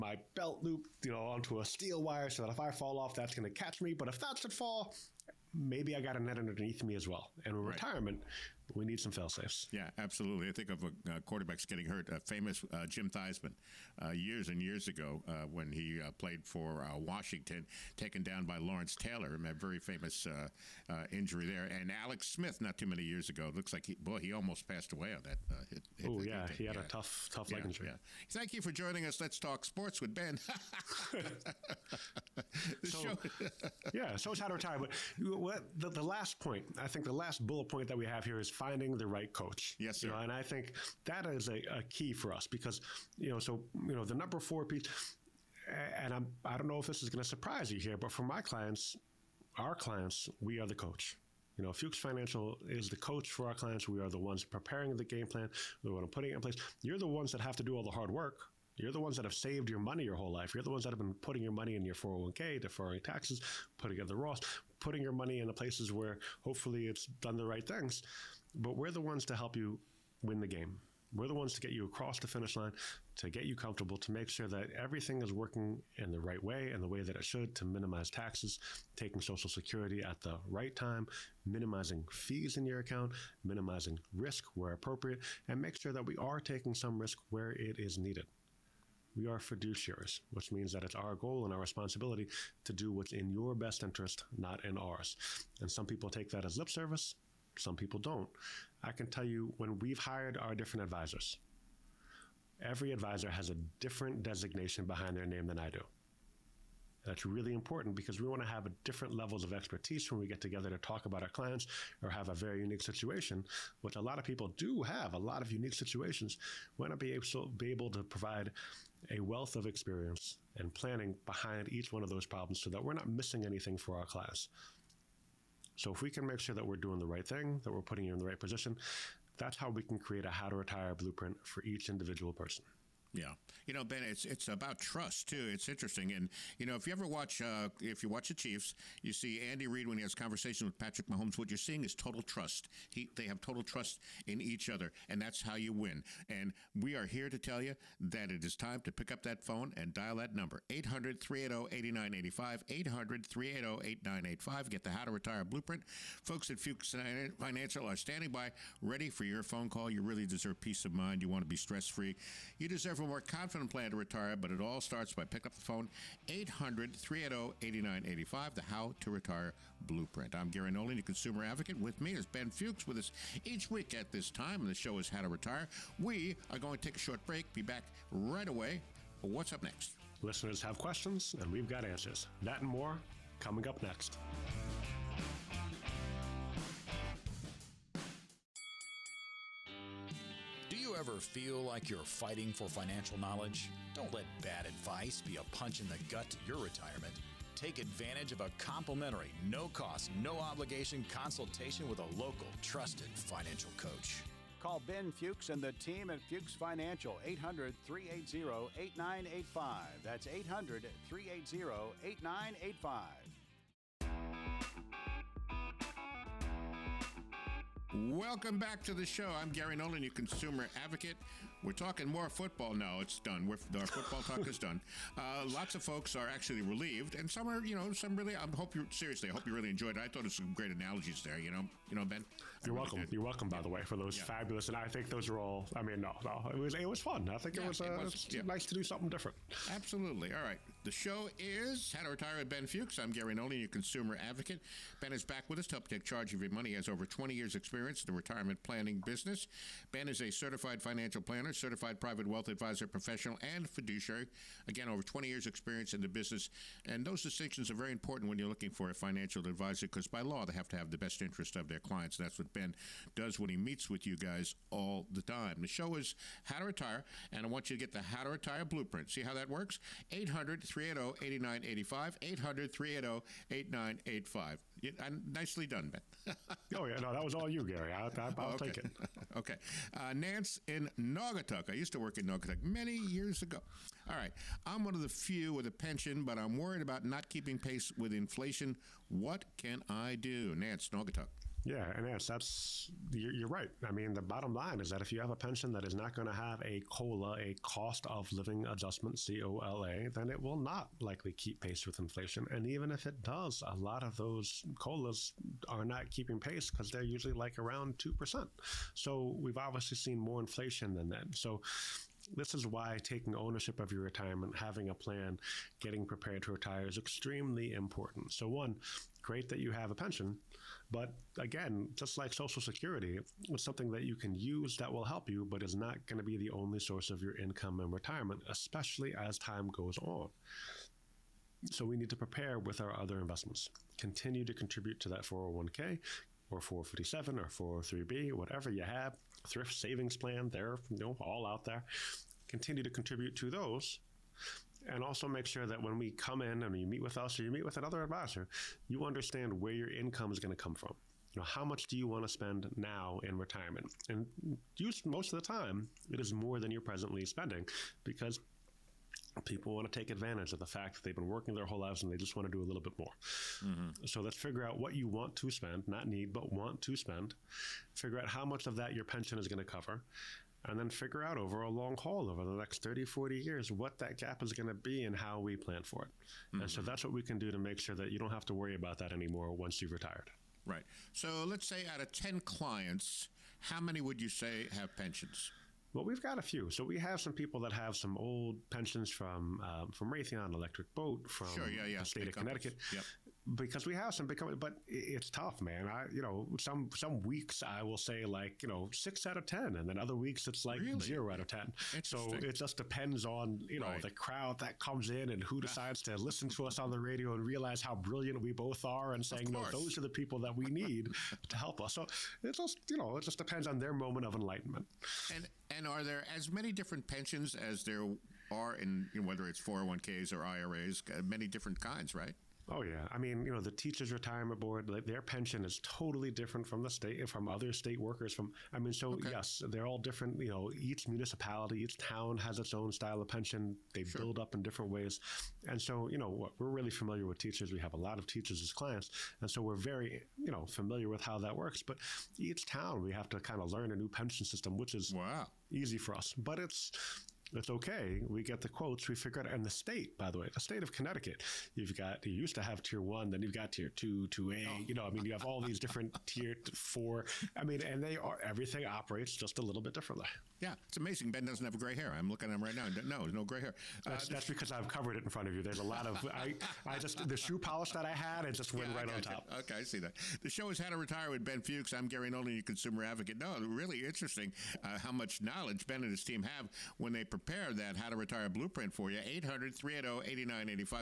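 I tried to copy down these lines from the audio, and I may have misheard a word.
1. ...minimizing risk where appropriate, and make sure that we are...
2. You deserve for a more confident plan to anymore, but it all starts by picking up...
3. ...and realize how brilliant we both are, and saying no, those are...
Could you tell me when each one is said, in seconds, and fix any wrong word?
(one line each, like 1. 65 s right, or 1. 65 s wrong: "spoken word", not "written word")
1. 83 s right
2. 162 s wrong: "retire", not "anymore"
3. 407 s right.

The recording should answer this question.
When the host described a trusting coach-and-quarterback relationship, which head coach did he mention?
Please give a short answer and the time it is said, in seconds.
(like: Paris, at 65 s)
Andy Reid, at 139 s.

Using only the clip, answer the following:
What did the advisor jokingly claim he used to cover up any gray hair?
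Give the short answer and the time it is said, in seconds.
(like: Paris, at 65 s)
Shoe polish, at 467 s.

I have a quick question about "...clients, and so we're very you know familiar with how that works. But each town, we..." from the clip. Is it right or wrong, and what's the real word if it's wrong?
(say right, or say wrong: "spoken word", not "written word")
right.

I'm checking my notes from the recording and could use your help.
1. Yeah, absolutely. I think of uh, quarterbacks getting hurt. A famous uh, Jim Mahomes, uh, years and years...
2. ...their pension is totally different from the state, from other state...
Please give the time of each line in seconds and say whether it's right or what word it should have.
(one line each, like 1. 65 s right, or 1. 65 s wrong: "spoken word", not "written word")
1. 9 s wrong: "Theismann", not "Mahomes"
2. 424 s right.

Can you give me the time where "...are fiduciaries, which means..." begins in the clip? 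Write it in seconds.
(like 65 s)
89 s.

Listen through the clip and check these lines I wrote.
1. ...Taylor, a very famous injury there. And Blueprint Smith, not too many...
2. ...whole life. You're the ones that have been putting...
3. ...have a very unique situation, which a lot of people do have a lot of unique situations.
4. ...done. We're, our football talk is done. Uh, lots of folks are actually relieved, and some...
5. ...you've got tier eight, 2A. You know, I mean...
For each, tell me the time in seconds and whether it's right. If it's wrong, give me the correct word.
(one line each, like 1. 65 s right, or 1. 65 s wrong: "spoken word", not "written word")
1. 18 s wrong: "Alex", not "Blueprint"
2. 60 s right
3. 112 s right
4. 223 s right
5. 453 s wrong: "two", not "eight".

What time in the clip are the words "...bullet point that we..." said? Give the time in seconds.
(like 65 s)
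37 s.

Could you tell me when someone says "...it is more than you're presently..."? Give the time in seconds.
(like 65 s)
356 s.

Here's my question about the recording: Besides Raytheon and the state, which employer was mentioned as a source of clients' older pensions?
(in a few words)
Electric Boat.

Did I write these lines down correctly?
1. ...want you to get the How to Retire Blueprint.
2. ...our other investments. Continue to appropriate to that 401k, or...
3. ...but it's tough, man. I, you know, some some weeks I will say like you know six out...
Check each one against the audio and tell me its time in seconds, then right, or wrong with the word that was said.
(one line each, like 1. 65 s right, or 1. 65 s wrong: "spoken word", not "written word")
1. 267 s right
2. 332 s wrong: "contribute", not "appropriate"
3. 394 s right.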